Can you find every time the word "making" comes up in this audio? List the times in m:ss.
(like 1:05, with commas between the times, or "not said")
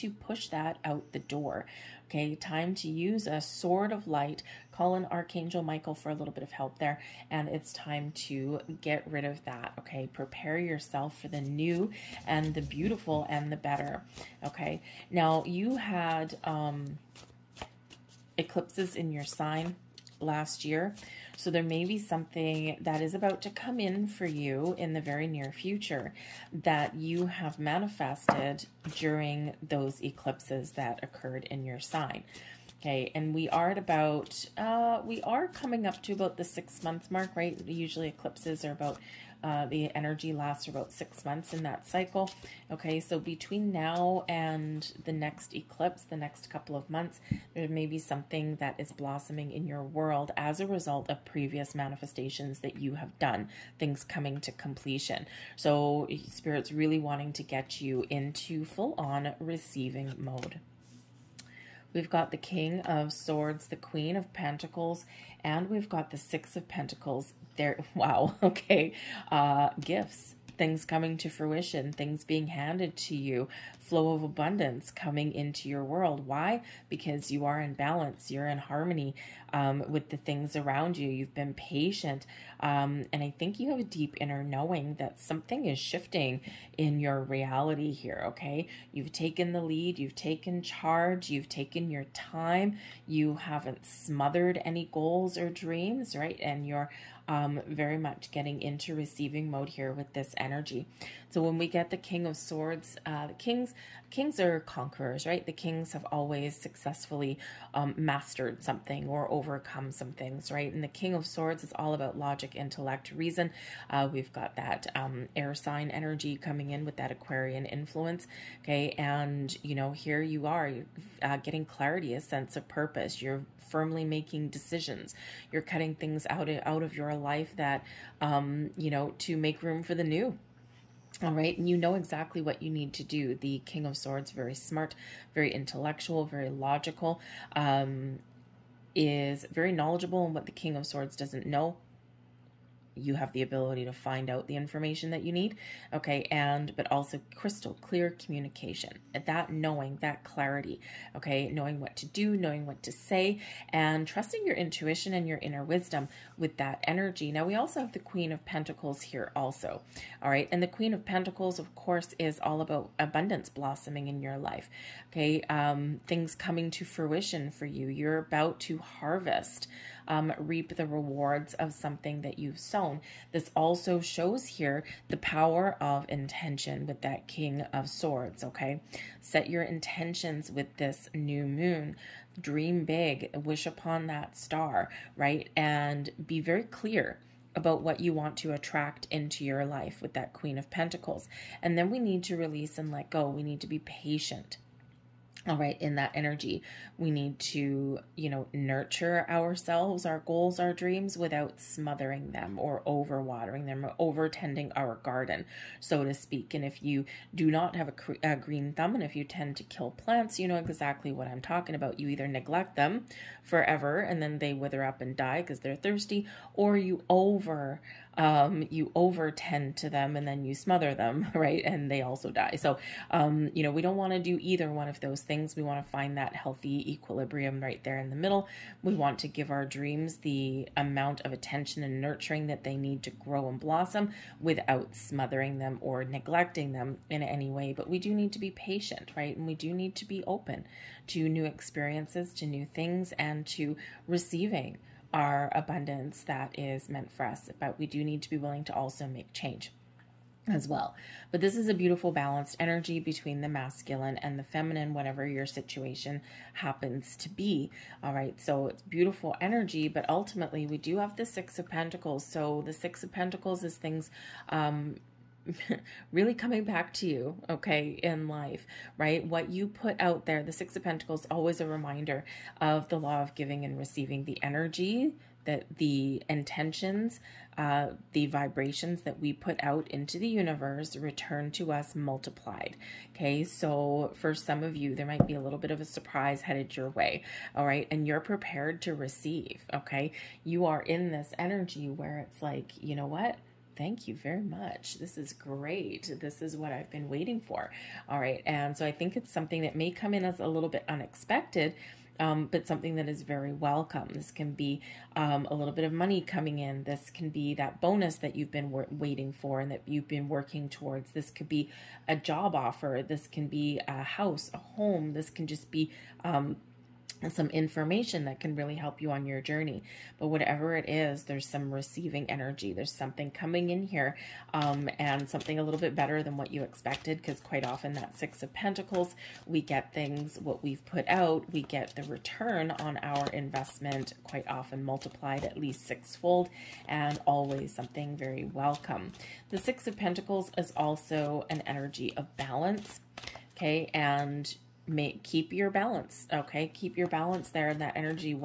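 2:04.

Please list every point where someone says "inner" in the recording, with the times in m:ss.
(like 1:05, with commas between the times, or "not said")
1:24, 2:35.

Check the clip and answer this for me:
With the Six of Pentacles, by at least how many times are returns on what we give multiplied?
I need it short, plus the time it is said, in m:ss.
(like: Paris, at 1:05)
6, at 5:35.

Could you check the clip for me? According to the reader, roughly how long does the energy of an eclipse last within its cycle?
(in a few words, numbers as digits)
6 months.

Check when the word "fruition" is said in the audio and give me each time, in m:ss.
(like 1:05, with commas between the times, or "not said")
1:11, 2:46.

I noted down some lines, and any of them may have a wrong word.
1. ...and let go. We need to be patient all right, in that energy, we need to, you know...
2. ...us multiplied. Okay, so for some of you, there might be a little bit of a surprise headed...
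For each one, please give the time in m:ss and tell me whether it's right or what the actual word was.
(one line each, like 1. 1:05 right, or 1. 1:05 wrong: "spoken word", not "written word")
1. 3:12 right
2. 4:41 right.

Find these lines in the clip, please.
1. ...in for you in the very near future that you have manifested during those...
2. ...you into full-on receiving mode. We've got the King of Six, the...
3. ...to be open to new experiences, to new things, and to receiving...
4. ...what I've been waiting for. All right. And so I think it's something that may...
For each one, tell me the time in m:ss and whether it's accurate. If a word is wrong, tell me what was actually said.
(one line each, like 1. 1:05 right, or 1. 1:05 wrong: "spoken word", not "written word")
1. 0:23 right
2. 0:57 wrong: "Swords", not "Six"
3. 3:59 right
4. 4:56 right.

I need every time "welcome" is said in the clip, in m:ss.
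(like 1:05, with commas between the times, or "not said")
5:03, 5:38.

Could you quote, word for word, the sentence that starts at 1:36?
And you're um, very much getting into receiving mode here with this energy.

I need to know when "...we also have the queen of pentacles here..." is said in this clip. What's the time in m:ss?
2:37.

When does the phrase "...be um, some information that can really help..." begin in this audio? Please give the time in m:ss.
5:15.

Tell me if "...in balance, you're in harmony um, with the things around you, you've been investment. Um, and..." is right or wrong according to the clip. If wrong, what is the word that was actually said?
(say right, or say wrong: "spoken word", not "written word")
wrong: "patient", not "investment".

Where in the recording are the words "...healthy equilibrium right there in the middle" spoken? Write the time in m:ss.
3:46.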